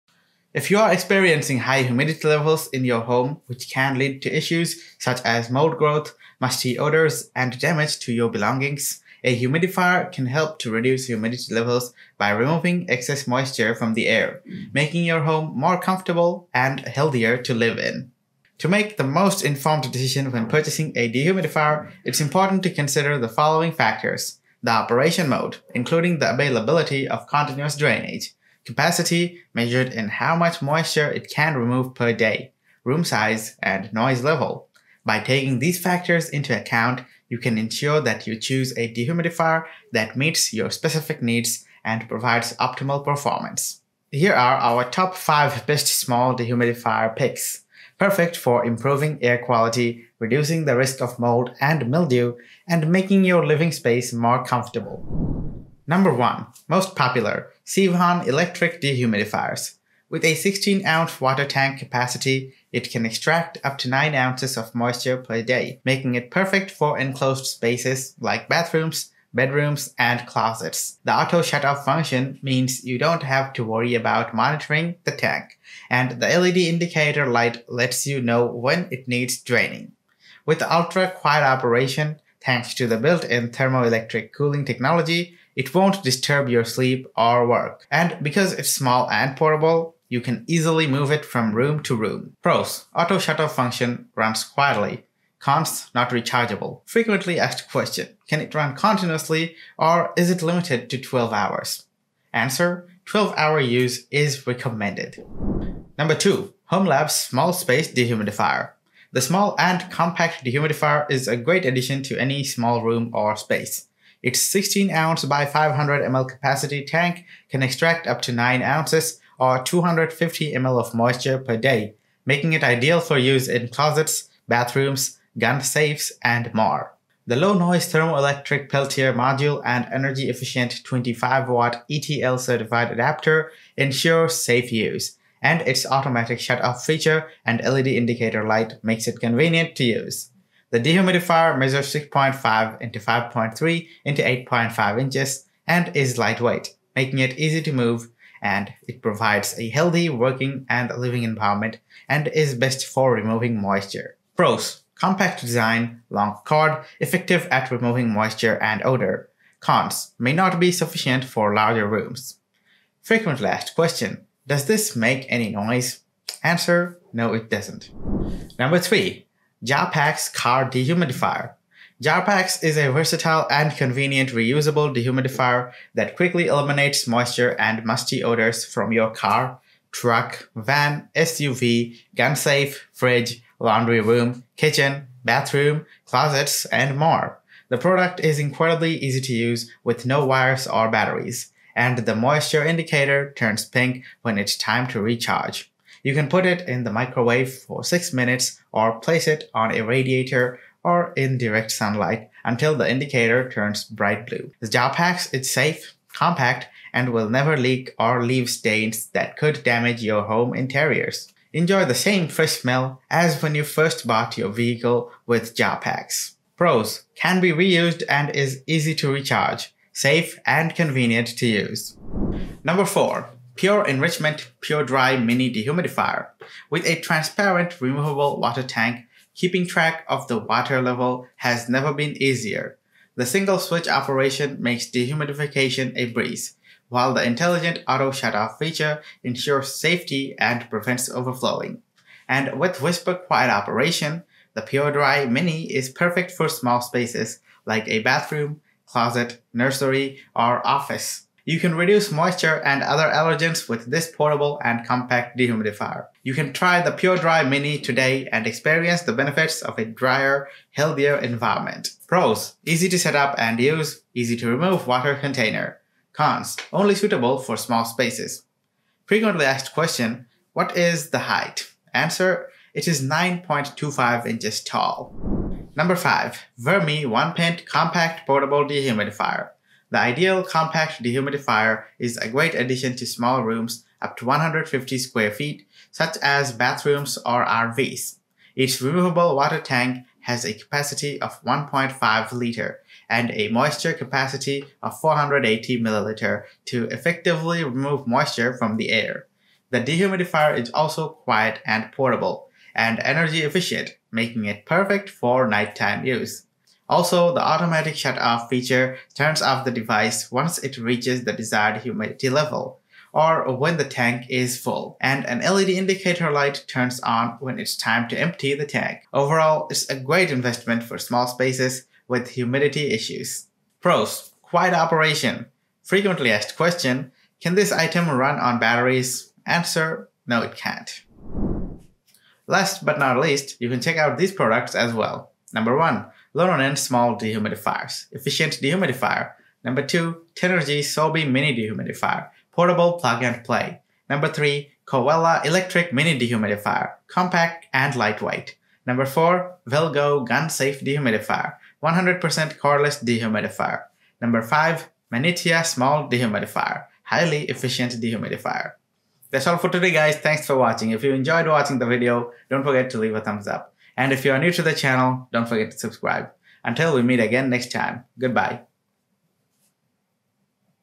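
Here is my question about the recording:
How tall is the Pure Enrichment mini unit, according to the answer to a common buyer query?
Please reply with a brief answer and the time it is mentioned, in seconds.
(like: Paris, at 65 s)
9.25 inches, at 273 s.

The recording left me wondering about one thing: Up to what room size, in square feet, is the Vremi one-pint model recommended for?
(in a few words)
150 square feet.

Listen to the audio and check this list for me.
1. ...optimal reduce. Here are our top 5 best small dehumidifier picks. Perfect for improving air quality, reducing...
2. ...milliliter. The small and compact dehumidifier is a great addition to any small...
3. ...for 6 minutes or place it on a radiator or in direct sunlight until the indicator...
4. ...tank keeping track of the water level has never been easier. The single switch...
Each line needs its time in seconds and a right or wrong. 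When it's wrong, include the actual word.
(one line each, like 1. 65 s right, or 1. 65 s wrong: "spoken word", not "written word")
1. 42 s wrong: "performance", not "reduce"
2. 107 s wrong: "dehumidifier", not "milliliter"
3. 197 s right
4. 228 s right.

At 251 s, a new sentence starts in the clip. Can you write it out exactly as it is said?
You can reduce moisture and other allergens with this portable and compact dehumidifier.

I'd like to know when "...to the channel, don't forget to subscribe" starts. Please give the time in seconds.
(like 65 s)
364 s.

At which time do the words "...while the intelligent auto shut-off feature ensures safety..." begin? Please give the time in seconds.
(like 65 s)
236 s.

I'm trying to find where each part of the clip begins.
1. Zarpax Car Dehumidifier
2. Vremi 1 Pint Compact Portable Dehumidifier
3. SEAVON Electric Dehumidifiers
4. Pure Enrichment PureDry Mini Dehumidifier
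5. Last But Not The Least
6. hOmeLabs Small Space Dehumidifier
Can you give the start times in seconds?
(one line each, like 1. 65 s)
1. 168 s
2. 275 s
3. 55 s
4. 222 s
5. 331 s
6. 105 s.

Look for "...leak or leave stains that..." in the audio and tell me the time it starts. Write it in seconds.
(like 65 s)
207 s.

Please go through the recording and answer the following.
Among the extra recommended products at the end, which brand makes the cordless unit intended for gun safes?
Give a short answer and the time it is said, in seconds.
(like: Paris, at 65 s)
Velgo, at 349 s.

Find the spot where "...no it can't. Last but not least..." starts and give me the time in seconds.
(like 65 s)
330 s.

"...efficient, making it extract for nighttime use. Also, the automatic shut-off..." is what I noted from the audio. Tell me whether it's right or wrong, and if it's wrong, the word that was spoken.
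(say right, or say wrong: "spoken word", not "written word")
wrong: "perfect", not "extract".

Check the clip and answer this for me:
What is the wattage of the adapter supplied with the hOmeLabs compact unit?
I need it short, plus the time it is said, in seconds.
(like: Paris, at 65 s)
25 watt, at 130 s.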